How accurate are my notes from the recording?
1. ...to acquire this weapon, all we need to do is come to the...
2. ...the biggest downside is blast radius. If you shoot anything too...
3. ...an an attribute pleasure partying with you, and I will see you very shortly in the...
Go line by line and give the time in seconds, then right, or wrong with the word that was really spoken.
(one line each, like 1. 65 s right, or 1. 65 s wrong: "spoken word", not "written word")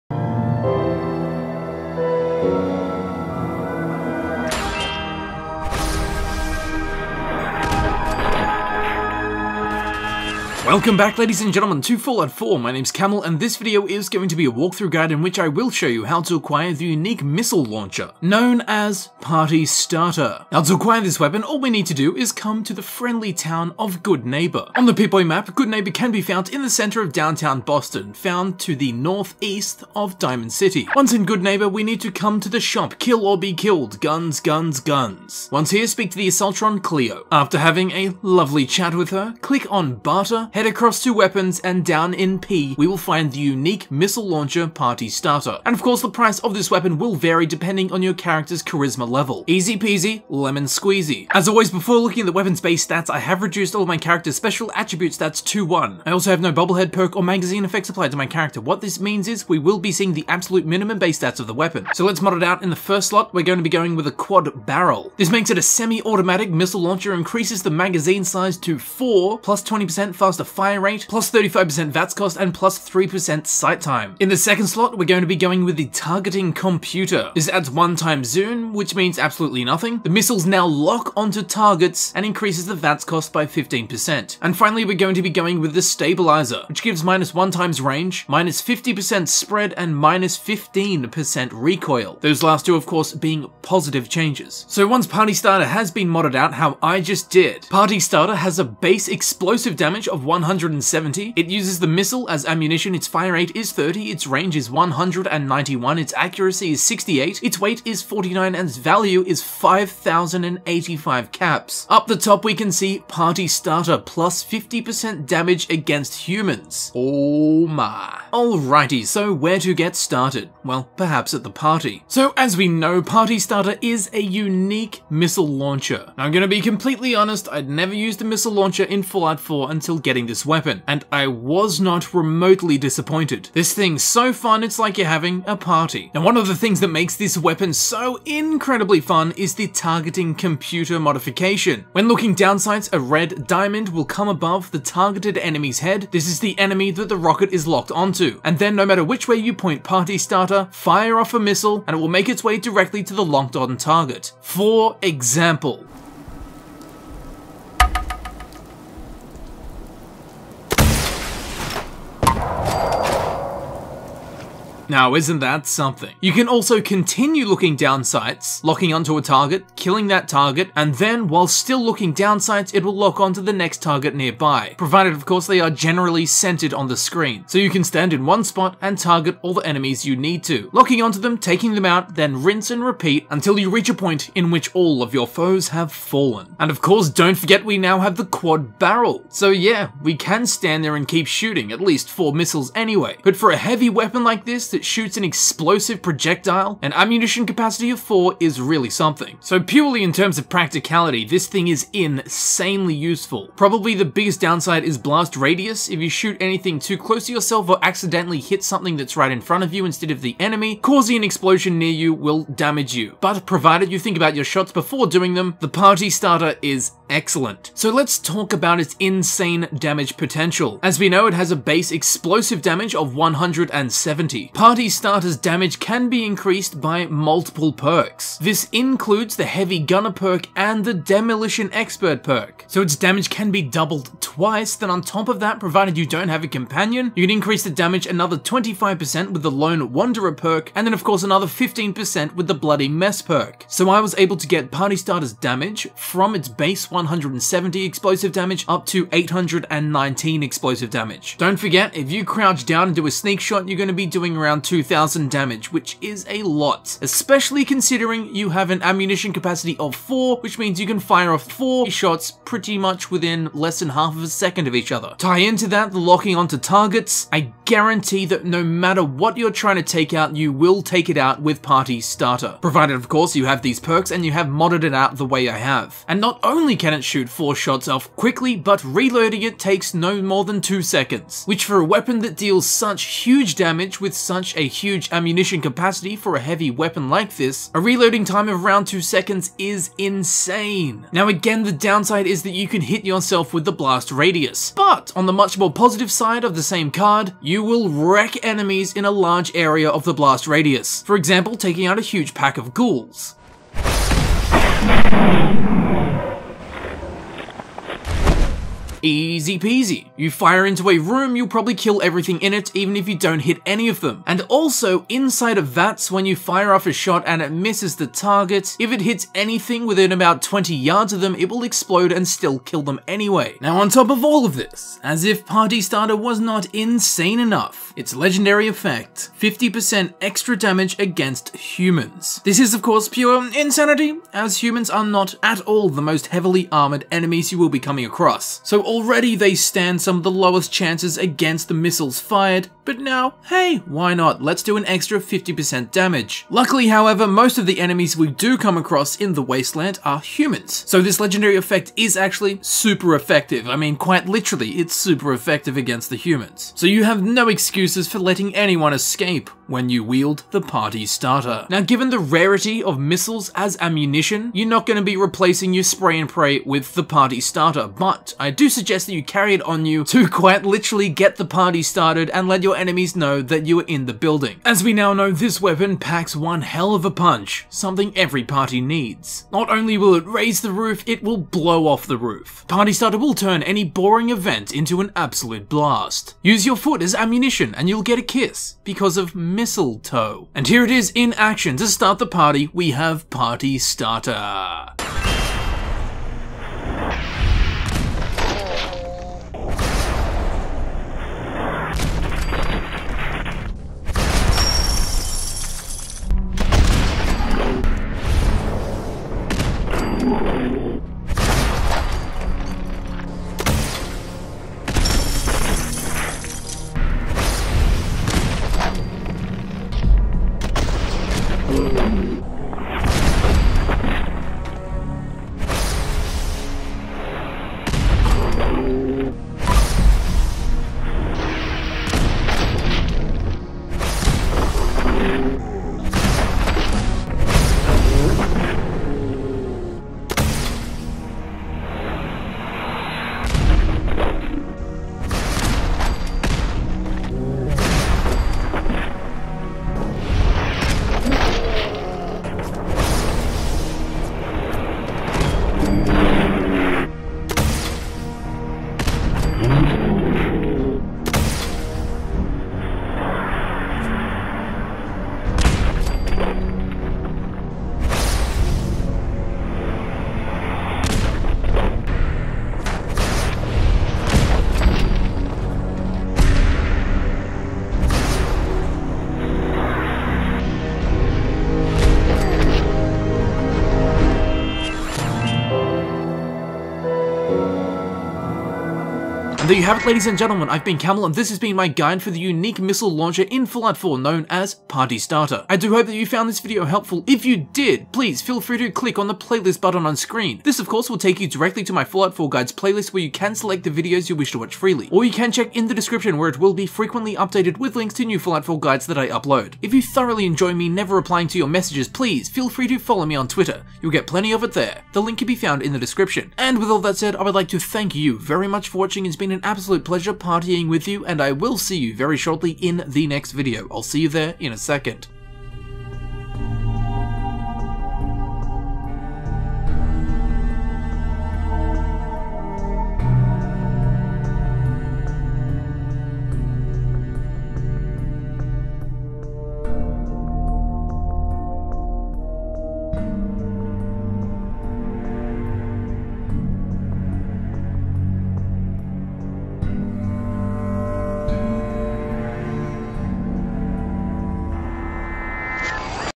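1. 20 s right
2. 203 s right
3. 519 s wrong: "absolute", not "attribute".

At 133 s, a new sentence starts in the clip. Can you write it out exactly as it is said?
This thing's so fun, it's like you're having a party.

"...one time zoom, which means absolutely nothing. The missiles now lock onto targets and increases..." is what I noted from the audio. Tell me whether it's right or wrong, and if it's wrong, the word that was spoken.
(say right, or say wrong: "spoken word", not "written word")
right.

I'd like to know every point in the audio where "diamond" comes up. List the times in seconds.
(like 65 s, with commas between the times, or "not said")
30 s, 143 s.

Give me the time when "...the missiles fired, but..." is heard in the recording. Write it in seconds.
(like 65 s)
341 s.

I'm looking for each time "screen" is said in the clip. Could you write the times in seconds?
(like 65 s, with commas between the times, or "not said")
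176 s, 500 s.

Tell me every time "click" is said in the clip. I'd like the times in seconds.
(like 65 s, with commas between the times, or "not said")
39 s, 498 s.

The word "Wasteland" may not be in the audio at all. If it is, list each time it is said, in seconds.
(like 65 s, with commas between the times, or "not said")
349 s.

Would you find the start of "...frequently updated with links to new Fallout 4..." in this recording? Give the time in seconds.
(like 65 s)
506 s.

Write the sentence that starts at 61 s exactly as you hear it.
So let's mod it out in the first slot, we're going to be going with a quad barrel.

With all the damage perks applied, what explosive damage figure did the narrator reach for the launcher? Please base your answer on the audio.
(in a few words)
819.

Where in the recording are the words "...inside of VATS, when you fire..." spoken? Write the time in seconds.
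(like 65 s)
315 s.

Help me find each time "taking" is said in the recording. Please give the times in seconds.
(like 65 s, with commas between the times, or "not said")
181 s, 301 s.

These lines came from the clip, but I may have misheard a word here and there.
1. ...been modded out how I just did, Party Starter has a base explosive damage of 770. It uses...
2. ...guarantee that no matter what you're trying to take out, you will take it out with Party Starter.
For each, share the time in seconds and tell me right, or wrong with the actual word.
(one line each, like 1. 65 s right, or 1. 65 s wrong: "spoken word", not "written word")
1. 95 s wrong: "170", not "770"
2. 267 s right.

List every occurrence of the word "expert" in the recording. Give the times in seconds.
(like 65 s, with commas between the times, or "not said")
231 s.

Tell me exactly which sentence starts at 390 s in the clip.
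And here it is in action to start the party, we have Party Starter.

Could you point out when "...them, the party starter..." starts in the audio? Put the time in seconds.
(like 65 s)
215 s.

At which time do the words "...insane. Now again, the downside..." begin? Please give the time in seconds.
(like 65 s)
289 s.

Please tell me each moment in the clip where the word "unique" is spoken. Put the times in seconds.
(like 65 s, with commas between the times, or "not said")
16 s, 43 s, 124 s, 492 s.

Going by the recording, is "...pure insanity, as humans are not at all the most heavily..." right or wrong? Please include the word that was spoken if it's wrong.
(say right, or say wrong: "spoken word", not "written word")
right.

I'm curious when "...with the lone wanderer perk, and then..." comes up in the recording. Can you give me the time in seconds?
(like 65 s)
239 s.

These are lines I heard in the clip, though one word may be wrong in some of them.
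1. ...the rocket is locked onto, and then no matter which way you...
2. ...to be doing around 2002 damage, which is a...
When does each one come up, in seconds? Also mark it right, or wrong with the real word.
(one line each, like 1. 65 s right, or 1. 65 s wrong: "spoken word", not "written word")
1. 147 s right
2. 253 s wrong: "2000", not "2002".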